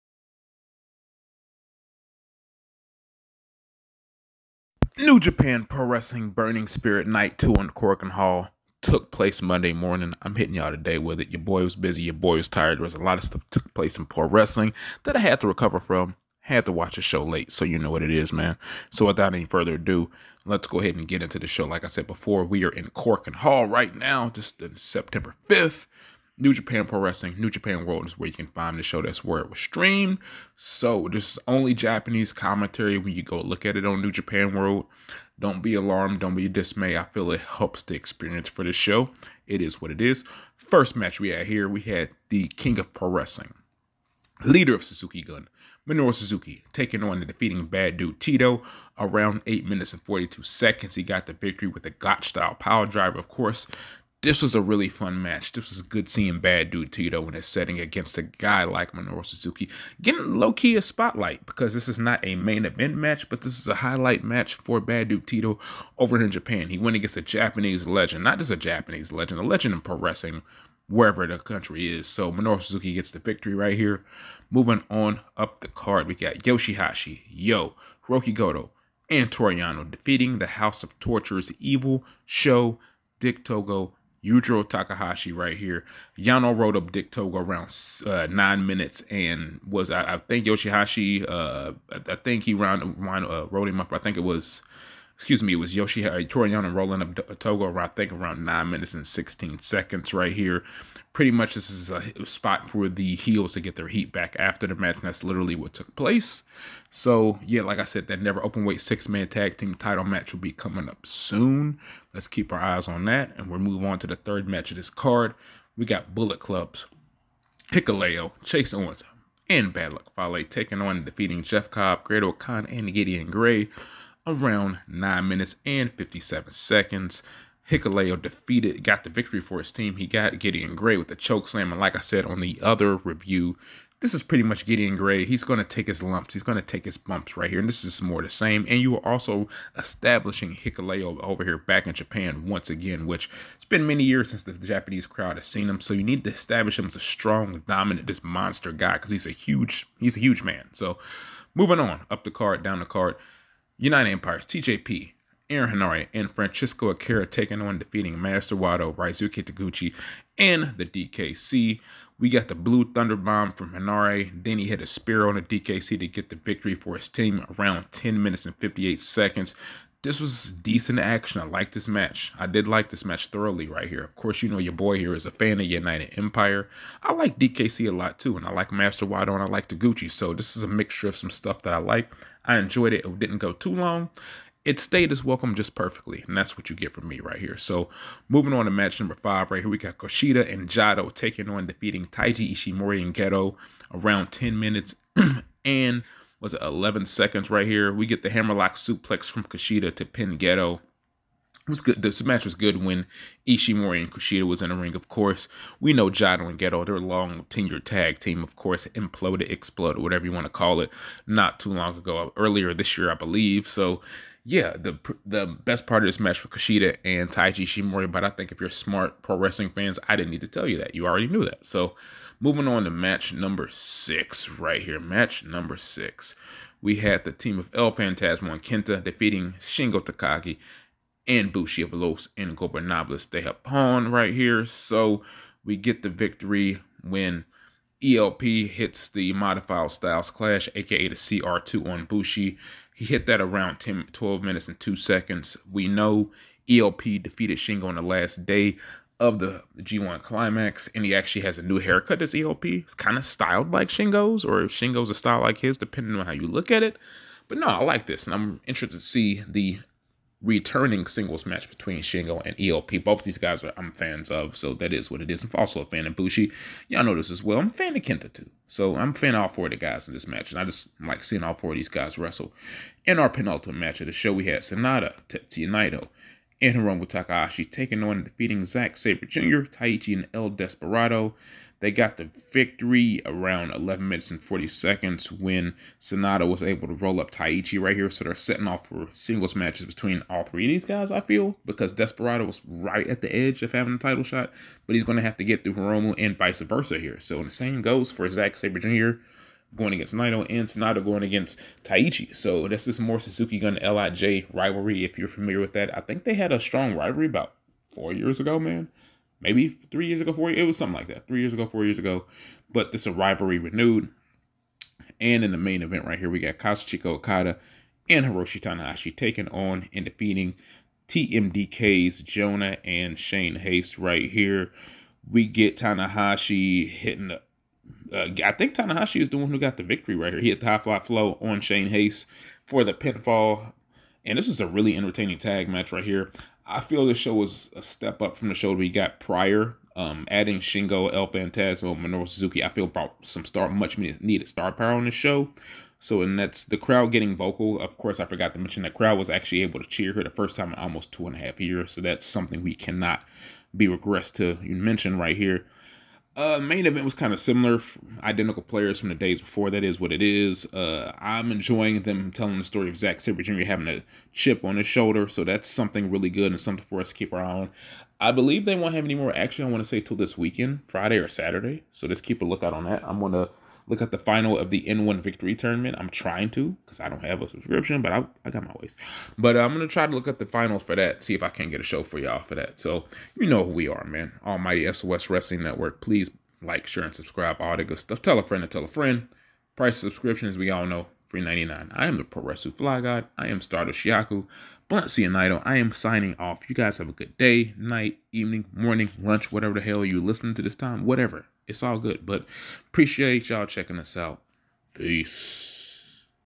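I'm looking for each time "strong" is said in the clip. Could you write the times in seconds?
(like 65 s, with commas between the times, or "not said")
146 s, 306 s.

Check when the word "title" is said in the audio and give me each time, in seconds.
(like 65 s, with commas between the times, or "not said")
109 s, 293 s.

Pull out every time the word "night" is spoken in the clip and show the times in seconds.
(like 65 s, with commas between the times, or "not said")
7 s, 397 s.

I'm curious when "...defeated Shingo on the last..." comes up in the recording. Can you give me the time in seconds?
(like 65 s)
247 s.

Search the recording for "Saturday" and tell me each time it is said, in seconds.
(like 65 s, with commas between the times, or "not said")
371 s.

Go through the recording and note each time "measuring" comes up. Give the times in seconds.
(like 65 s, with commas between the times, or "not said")
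not said.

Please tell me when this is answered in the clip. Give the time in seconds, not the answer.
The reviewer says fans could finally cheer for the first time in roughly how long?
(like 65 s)
351 s.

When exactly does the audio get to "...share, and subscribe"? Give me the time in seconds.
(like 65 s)
386 s.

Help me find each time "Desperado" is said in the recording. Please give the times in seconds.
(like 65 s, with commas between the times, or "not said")
280 s, 291 s.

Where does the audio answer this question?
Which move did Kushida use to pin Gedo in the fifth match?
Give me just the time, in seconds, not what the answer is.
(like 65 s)
198 s.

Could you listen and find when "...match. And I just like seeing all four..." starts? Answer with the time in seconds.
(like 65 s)
270 s.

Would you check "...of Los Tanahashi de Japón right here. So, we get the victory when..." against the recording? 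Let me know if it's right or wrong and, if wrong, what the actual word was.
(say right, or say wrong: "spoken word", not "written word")
wrong: "Ingobernables", not "Tanahashi".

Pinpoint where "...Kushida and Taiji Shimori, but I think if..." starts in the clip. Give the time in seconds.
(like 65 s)
216 s.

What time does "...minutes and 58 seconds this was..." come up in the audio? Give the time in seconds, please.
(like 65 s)
168 s.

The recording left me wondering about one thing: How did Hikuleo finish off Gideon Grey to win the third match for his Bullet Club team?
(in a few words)
Choke slam.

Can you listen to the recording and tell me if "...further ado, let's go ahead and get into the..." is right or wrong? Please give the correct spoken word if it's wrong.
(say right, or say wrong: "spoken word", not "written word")
right.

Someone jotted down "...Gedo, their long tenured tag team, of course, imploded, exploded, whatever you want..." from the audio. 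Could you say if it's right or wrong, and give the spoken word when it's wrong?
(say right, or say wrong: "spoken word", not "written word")
right.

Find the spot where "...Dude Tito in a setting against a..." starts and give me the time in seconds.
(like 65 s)
56 s.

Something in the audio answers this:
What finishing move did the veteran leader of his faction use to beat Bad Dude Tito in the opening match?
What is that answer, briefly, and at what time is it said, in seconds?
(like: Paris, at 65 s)
Gotch style piledriver, at 51 s.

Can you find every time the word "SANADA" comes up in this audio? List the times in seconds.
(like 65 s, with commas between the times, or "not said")
274 s, 285 s, 300 s.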